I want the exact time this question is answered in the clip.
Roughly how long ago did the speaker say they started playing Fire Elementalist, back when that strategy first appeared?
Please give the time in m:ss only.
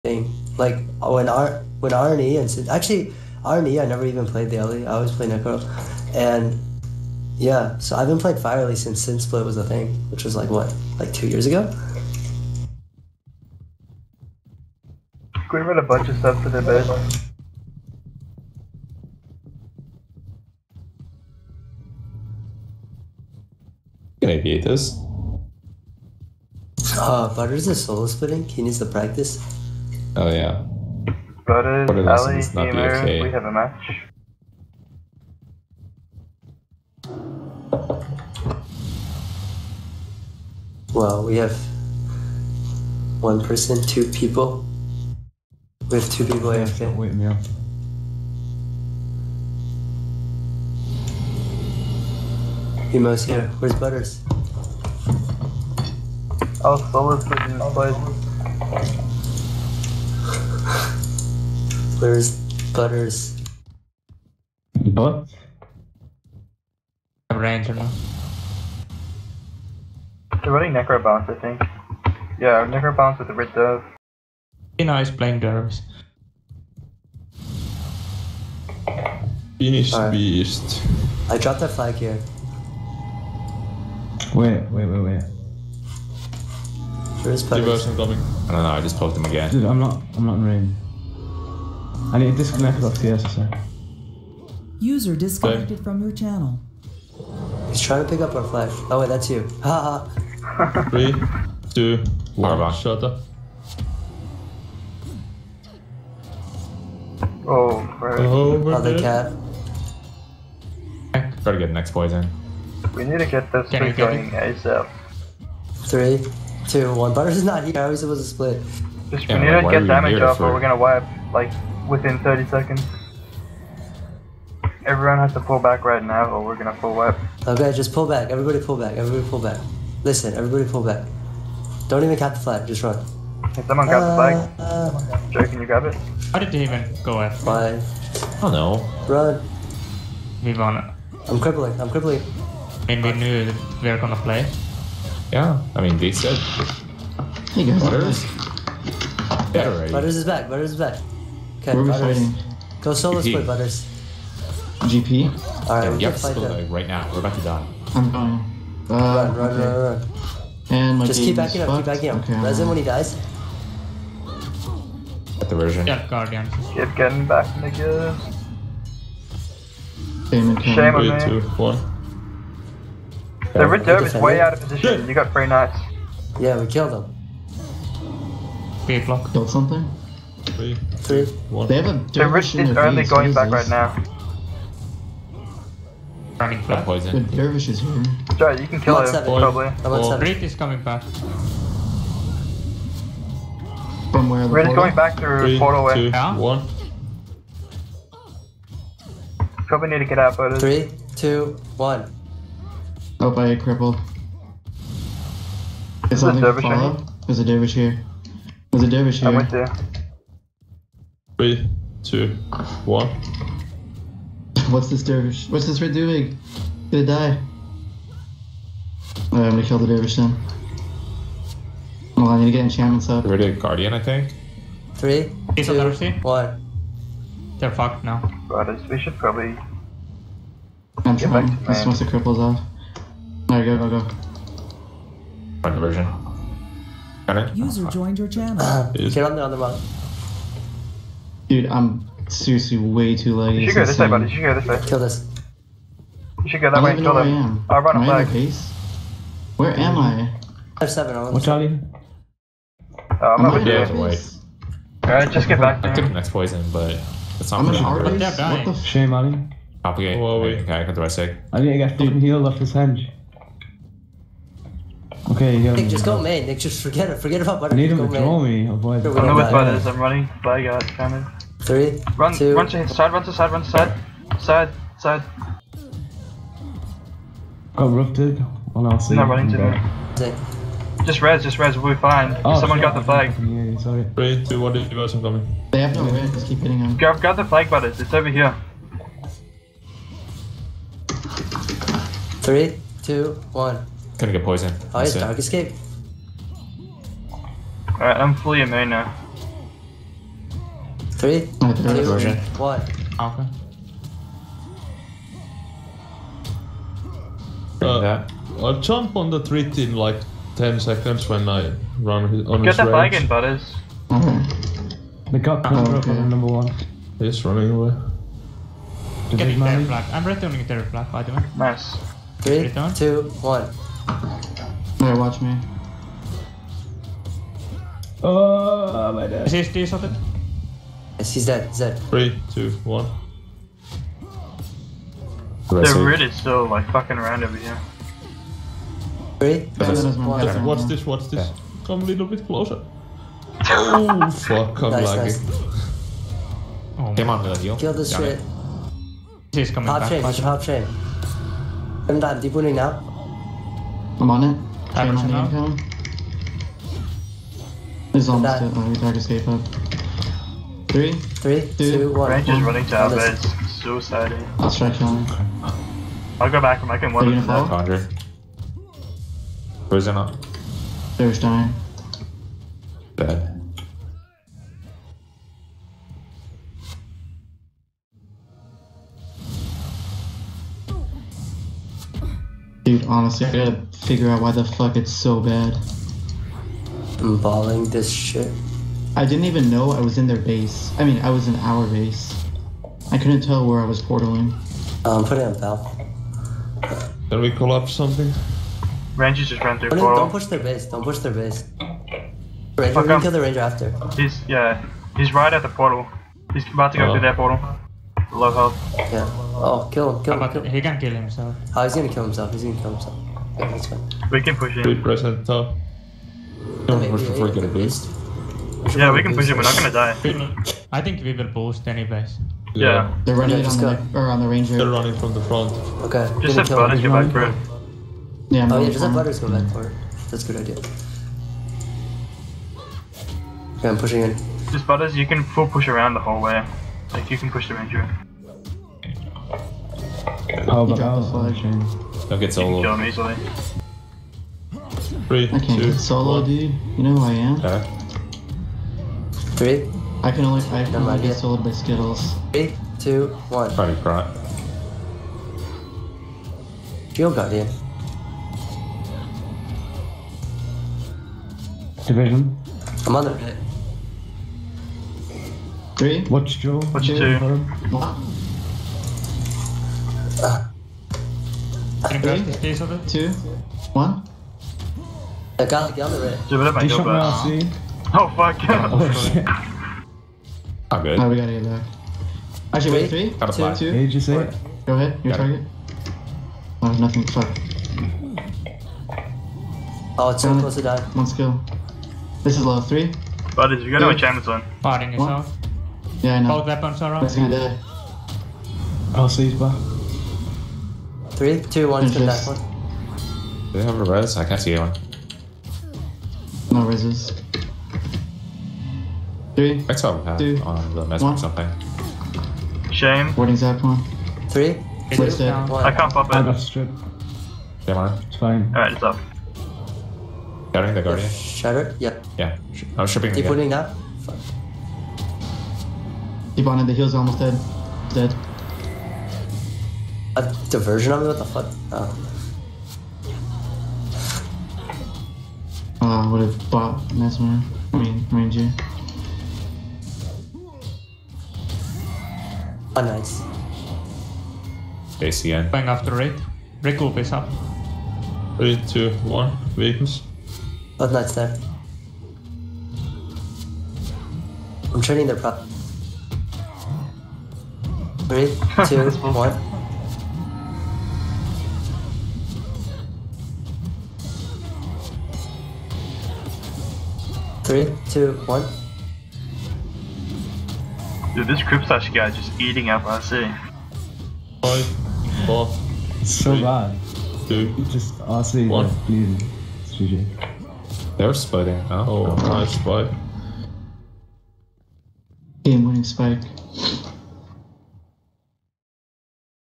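0:11.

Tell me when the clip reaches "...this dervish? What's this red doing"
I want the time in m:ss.
3:34.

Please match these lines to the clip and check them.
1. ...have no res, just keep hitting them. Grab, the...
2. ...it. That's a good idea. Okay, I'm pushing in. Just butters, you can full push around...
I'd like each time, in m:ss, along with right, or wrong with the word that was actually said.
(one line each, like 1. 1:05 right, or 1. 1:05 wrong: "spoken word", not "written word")
1. 4:45 right
2. 7:09 right.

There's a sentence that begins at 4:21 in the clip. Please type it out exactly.
I think I got fucking healed off this hand.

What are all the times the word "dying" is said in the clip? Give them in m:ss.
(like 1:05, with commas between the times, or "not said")
2:38, 6:11.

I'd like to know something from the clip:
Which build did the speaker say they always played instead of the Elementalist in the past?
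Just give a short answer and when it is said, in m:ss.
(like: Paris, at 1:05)
Necro, at 0:05.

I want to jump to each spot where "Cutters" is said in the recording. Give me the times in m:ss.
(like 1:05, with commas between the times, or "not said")
1:02, 1:27.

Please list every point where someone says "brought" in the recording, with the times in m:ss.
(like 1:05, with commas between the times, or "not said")
7:34.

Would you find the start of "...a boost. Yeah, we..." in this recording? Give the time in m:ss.
6:57.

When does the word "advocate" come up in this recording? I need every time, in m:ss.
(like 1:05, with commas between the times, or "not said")
not said.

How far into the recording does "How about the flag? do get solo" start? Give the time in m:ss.
7:20.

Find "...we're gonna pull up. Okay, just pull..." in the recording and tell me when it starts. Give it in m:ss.
2:06.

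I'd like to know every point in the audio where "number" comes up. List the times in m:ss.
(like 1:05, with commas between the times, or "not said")
5:16.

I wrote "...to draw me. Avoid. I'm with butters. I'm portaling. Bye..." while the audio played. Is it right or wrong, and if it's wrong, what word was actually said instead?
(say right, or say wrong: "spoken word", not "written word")
wrong: "running", not "portaling".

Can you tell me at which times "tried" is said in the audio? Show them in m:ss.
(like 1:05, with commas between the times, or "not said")
5:58.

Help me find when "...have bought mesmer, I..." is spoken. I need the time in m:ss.
8:56.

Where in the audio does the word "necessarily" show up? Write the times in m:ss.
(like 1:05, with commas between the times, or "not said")
not said.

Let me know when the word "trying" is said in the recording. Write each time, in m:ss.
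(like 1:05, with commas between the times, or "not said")
1:37, 3:51.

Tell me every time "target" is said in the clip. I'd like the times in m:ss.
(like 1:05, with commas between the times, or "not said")
8:05.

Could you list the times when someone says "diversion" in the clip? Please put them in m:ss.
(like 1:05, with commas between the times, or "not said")
1:27, 8:50.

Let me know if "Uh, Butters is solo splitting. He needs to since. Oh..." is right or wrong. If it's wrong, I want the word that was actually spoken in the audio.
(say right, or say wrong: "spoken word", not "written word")
wrong: "practice", not "since".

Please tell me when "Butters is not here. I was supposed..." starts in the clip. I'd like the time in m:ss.
1:57.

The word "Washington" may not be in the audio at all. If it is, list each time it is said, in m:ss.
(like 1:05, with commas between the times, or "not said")
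not said.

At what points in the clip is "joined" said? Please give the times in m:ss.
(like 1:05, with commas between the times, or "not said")
3:57.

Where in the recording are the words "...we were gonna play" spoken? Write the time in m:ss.
2:23.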